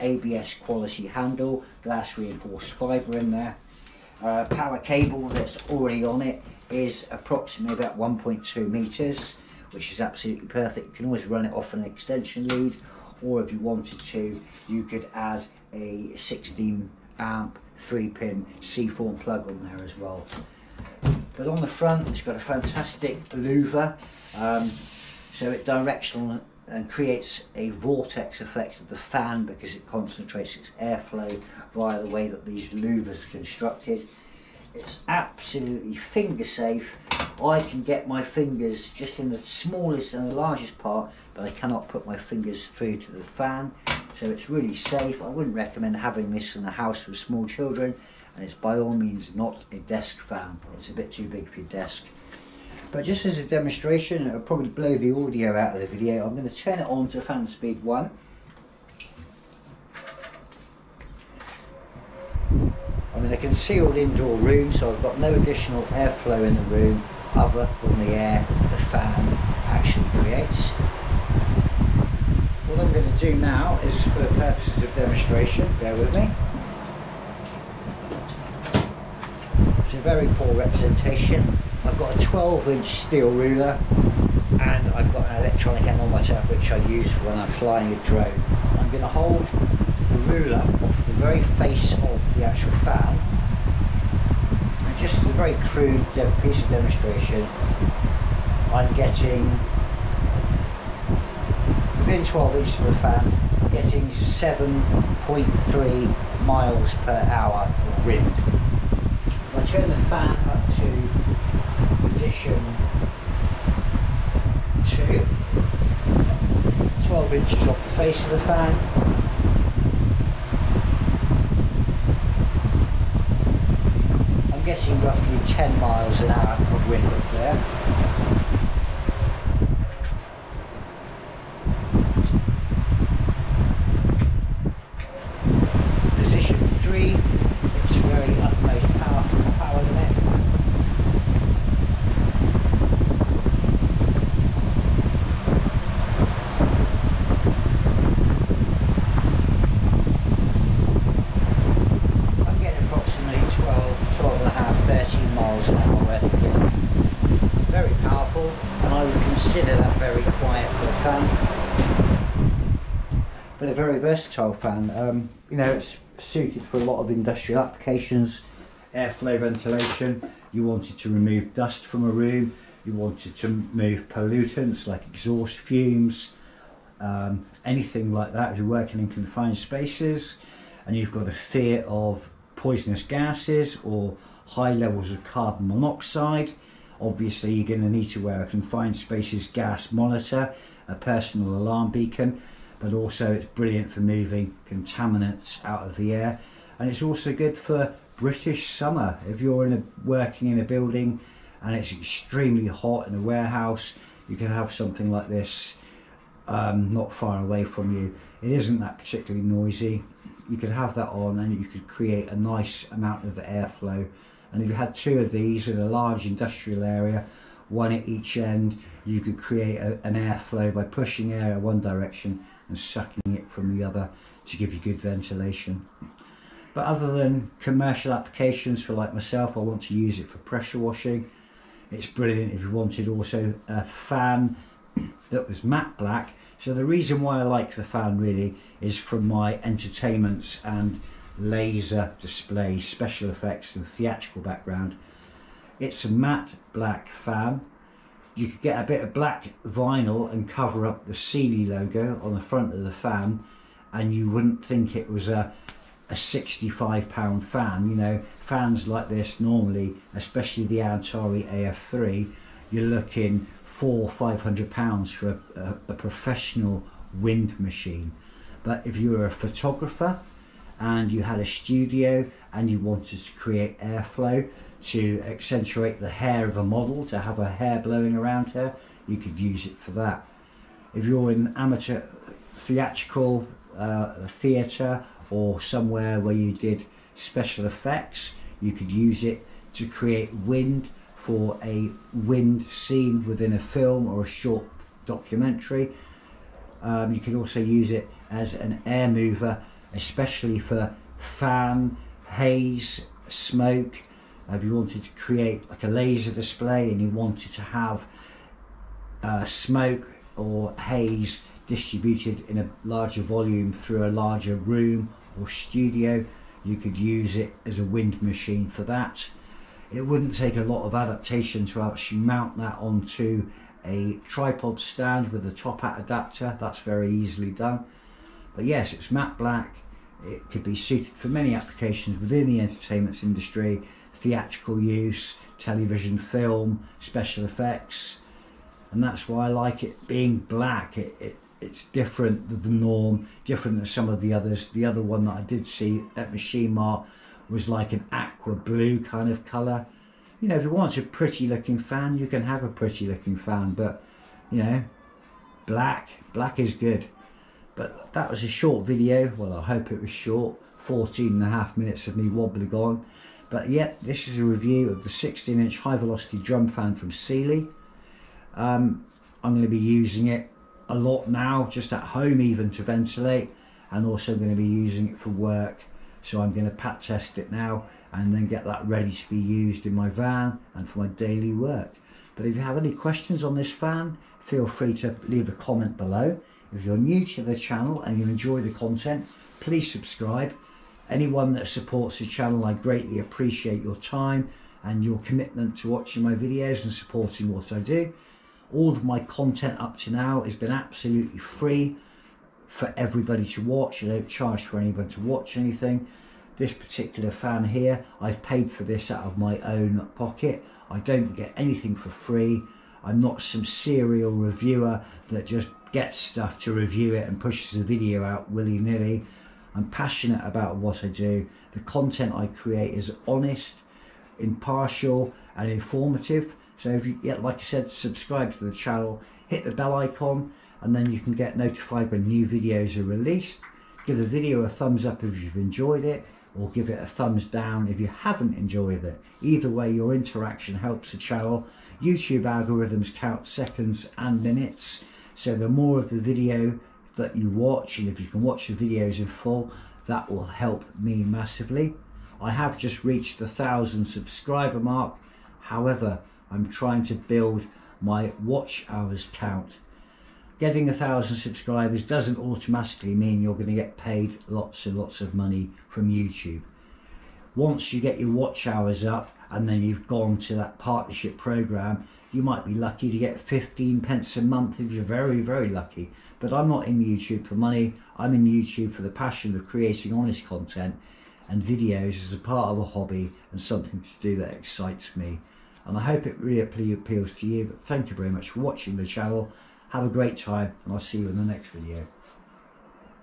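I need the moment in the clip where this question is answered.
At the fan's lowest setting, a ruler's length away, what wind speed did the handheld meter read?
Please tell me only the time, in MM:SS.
01:44.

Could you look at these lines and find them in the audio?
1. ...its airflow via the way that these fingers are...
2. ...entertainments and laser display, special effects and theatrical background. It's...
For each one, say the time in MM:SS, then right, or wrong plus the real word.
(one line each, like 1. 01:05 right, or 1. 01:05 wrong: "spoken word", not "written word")
1. 00:30 wrong: "louvers", not "fingers"
2. 03:59 right.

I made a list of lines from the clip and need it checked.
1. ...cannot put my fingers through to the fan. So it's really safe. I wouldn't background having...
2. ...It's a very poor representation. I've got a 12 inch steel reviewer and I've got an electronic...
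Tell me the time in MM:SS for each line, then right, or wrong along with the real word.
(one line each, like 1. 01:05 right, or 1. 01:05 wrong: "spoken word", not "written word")
1. 00:41 wrong: "recommend", not "background"
2. 01:19 wrong: "ruler", not "reviewer".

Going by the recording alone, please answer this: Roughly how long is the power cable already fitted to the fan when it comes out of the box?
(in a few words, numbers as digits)
1.2 meters.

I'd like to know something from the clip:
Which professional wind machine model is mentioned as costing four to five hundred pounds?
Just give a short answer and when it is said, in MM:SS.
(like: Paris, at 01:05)
Antari AF3, at 04:20.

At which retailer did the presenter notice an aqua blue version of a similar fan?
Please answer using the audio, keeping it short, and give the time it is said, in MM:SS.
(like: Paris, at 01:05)
Machine Mart, at 05:46.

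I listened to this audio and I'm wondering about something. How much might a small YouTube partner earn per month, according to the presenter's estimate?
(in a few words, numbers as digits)
15 pence.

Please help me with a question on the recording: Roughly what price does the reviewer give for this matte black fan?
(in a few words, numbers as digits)
65 pounds.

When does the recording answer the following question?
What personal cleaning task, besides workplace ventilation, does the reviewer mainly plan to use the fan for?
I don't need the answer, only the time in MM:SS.
03:50.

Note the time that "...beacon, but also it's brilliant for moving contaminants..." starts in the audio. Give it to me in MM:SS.
03:11.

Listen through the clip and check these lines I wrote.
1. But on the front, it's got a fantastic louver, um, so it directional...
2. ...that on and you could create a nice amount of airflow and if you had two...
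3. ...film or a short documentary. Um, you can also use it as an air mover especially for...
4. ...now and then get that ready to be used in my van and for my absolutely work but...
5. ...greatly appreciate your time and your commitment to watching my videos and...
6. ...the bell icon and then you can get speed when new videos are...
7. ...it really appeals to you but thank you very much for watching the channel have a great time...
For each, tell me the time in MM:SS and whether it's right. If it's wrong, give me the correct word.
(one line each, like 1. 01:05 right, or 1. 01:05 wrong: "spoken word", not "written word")
1. 00:21 right
2. 03:30 right
3. 04:53 right
4. 06:17 wrong: "daily", not "absolutely"
5. 06:32 right
6. 07:09 wrong: "notified", not "speed"
7. 08:06 right.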